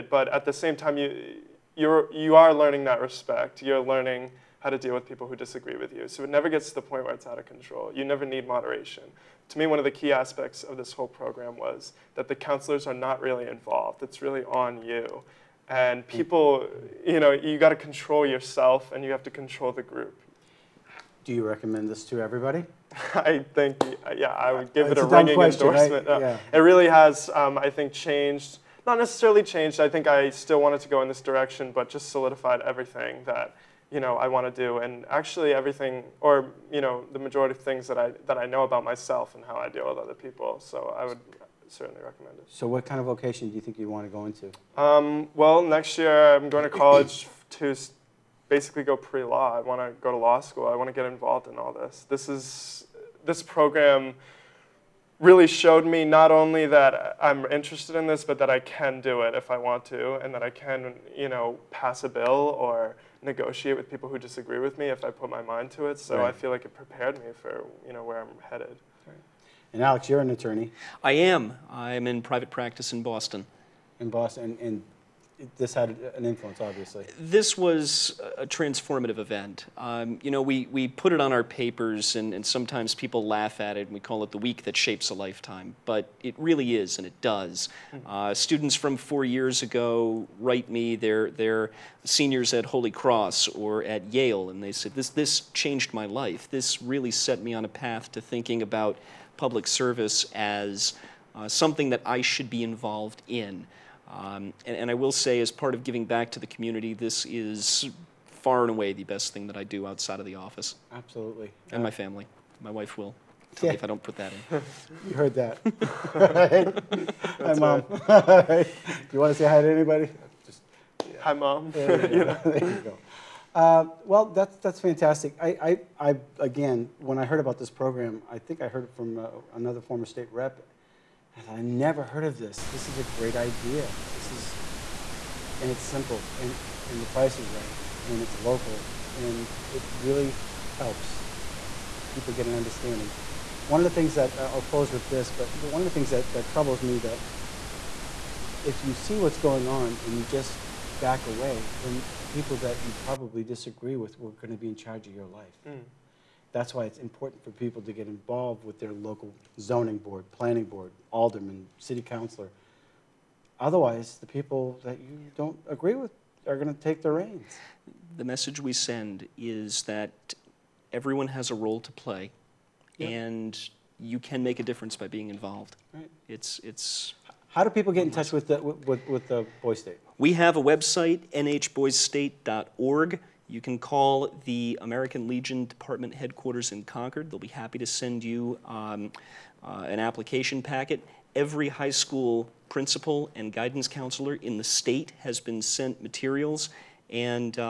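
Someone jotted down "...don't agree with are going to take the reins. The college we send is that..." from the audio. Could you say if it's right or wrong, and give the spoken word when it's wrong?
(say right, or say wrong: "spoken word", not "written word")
wrong: "message", not "college".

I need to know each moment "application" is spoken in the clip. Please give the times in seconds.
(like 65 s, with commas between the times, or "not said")
190 s.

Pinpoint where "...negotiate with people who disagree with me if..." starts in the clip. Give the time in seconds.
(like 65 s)
63 s.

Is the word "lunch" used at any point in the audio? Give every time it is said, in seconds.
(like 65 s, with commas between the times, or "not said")
not said.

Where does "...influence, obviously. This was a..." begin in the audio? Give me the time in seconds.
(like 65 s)
76 s.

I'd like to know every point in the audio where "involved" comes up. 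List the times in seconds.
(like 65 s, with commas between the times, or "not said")
13 s, 51 s, 102 s, 158 s, 175 s.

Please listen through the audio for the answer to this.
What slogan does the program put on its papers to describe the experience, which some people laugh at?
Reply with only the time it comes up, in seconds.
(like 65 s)
84 s.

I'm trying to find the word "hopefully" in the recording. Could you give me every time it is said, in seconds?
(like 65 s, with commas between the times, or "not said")
not said.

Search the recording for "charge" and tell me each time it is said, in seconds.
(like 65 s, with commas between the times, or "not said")
154 s.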